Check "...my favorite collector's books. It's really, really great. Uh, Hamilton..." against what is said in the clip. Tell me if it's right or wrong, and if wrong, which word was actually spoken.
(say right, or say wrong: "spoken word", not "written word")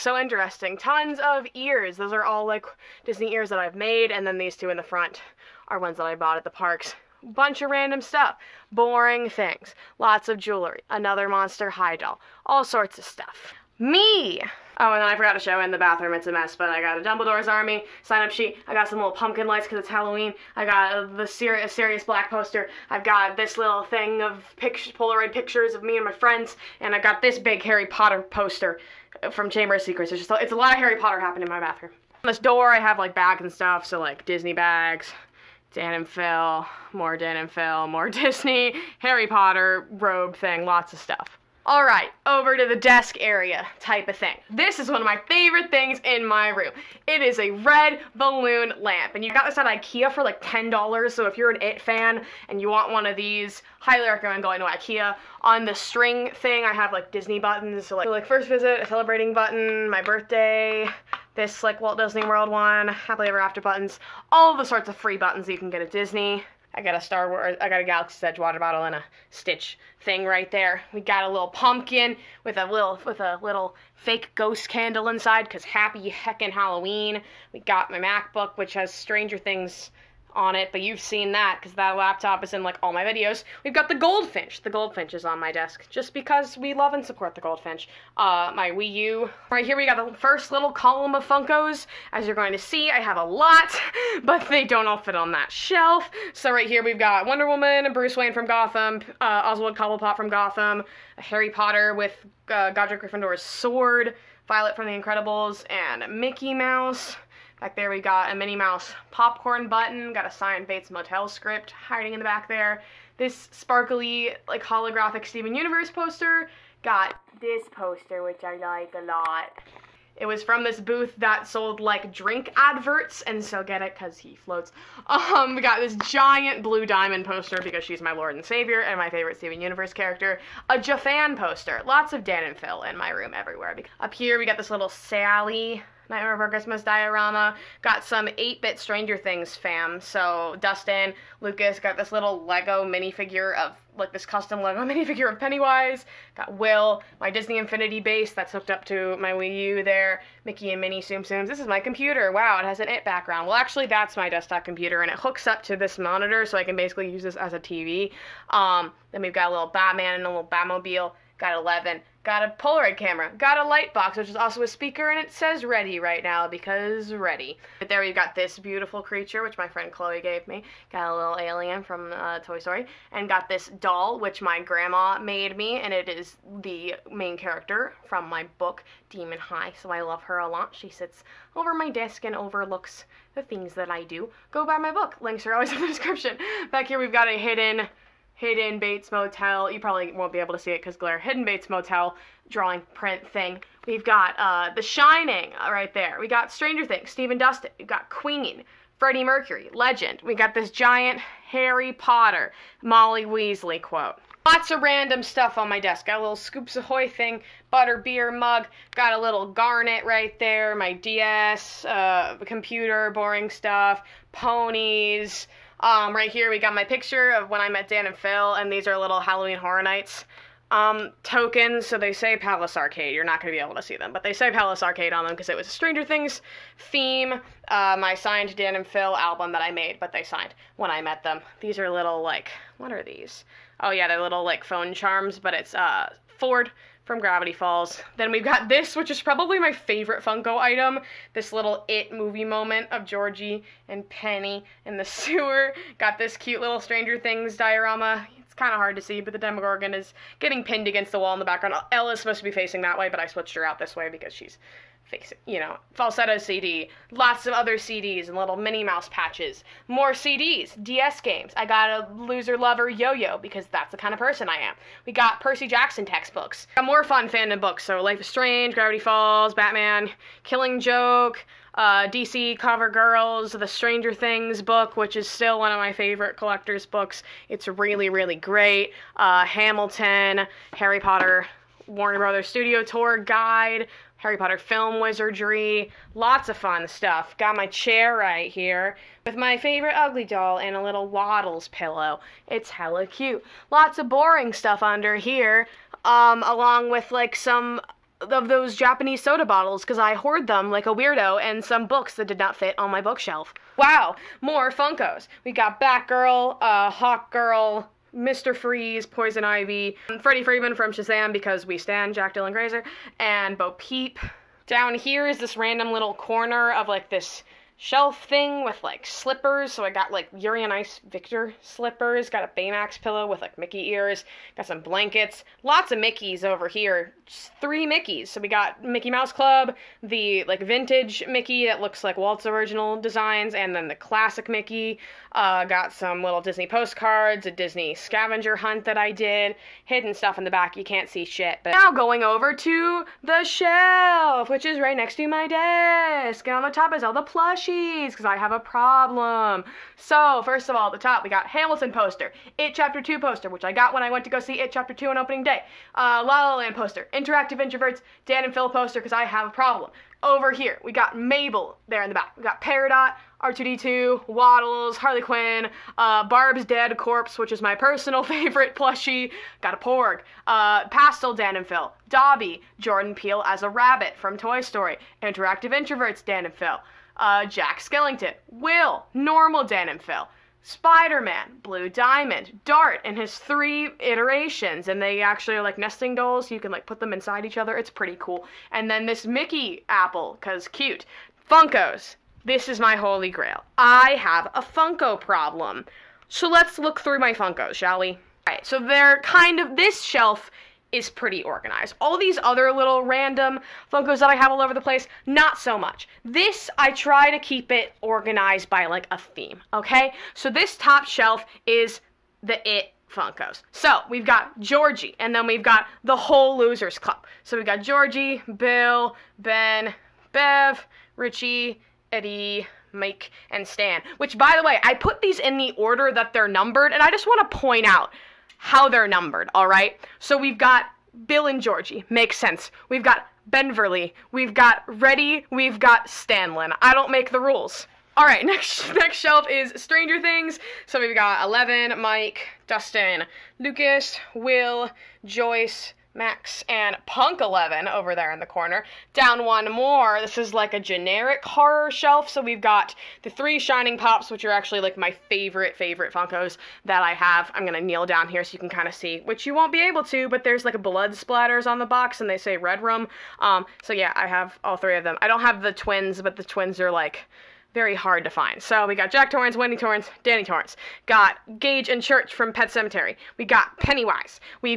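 right.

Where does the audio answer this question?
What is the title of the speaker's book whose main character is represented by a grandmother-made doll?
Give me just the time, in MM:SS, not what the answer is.
02:58.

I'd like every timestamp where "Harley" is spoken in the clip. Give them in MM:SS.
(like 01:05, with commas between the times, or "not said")
06:04.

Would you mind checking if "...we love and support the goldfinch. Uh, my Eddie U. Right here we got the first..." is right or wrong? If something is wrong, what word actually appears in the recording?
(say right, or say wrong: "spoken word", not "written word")
wrong: "Wii", not "Eddie".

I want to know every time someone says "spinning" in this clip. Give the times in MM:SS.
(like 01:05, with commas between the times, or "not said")
not said.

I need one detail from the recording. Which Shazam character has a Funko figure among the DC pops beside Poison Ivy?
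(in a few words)
Freddy Freeman.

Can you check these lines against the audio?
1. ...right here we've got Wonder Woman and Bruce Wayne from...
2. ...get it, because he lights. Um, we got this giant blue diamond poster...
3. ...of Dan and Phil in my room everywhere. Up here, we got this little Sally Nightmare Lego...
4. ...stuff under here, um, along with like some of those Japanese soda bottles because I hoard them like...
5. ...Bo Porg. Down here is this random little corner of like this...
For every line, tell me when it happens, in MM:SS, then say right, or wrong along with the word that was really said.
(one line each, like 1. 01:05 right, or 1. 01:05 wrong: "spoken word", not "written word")
1. 01:36 right
2. 02:03 wrong: "floats", not "lights"
3. 02:12 wrong: "Before", not "Lego"
4. 04:54 right
5. 05:13 wrong: "Peep", not "Porg".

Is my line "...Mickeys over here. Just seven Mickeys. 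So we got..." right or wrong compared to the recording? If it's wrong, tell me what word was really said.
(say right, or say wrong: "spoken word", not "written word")
wrong: "three", not "seven".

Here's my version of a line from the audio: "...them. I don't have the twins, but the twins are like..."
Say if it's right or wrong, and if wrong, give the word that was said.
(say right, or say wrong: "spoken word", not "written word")
right.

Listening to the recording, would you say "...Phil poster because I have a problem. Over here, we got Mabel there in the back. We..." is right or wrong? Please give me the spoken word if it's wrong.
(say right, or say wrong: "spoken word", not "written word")
right.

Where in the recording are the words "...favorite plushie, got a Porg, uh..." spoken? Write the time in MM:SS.
06:08.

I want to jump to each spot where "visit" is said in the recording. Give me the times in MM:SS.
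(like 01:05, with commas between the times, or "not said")
00:58.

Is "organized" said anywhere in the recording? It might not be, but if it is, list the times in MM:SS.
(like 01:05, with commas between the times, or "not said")
06:41, 06:48.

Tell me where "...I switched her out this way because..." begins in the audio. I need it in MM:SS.
04:13.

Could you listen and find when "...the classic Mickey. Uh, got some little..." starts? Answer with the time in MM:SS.
05:33.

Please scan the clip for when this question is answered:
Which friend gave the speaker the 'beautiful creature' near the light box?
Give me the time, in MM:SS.
02:49.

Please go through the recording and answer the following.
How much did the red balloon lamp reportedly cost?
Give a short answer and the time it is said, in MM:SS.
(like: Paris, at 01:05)
$10, at 00:50.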